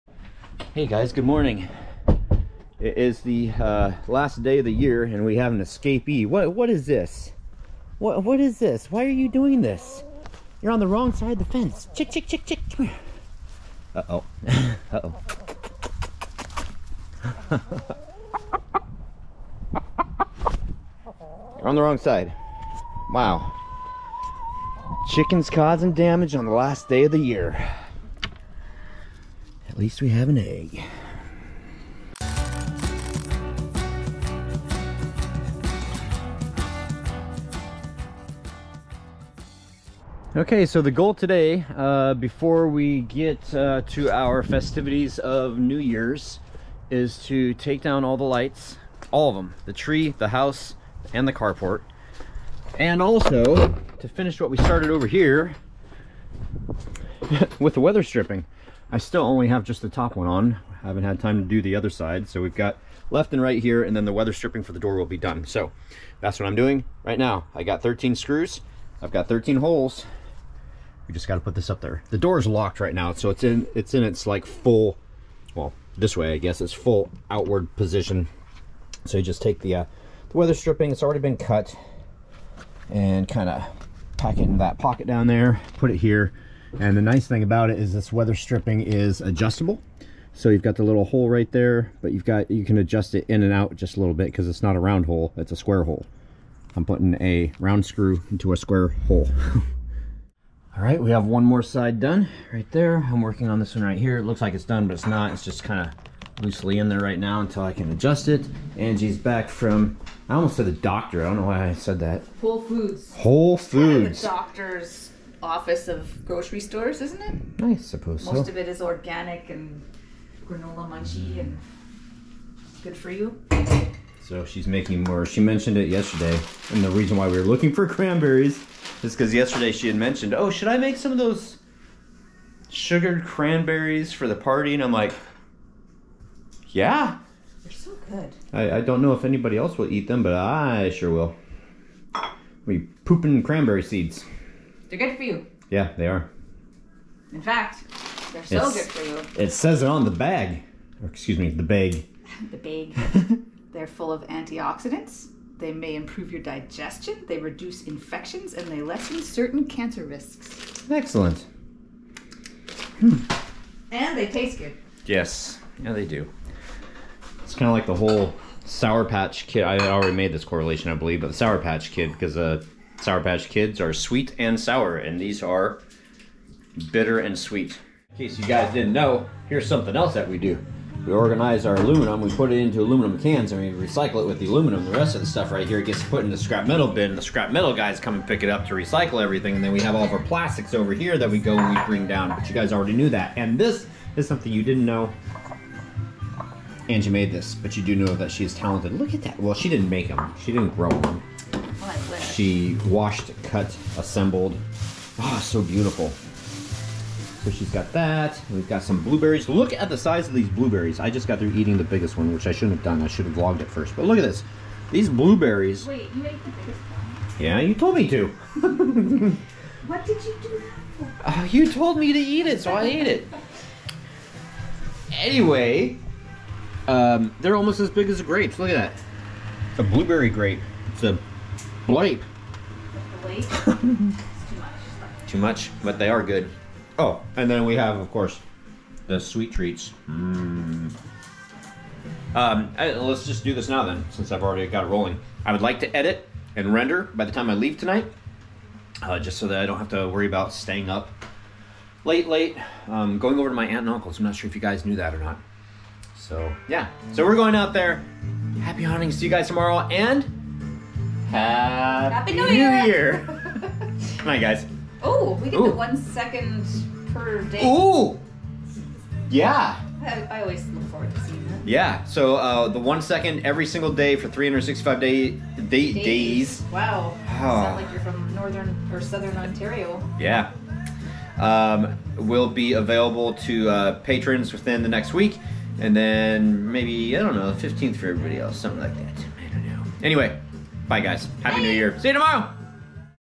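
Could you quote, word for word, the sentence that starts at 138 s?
I, I don't know if anybody else will eat them, but I sure will.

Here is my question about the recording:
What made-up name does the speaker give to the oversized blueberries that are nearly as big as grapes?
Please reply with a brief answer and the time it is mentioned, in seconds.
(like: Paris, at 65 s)
Blape, at 231 s.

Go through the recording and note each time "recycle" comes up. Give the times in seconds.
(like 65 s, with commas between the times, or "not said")
183 s, 188 s.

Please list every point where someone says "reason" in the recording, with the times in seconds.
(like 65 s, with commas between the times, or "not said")
126 s.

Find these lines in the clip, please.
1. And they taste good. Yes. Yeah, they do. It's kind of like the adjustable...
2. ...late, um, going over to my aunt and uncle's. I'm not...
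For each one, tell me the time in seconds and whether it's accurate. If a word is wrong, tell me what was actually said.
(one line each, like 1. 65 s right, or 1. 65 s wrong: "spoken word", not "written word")
1. 163 s wrong: "whole", not "adjustable"
2. 252 s right.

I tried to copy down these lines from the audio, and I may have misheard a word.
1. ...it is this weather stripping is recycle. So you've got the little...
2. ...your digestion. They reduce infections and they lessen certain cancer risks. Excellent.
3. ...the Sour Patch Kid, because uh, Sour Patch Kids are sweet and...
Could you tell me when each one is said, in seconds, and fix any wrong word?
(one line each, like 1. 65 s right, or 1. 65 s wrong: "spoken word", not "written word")
1. 87 s wrong: "adjustable", not "recycle"
2. 156 s right
3. 171 s right.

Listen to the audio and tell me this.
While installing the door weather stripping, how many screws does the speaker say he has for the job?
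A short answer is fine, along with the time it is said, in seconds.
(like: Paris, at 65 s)
13, at 67 s.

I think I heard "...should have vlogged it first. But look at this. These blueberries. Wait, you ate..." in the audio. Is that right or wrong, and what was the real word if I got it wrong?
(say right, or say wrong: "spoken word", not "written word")
right.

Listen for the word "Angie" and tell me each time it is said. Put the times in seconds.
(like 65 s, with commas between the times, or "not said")
108 s, 196 s.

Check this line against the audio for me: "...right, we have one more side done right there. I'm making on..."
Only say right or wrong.
wrong.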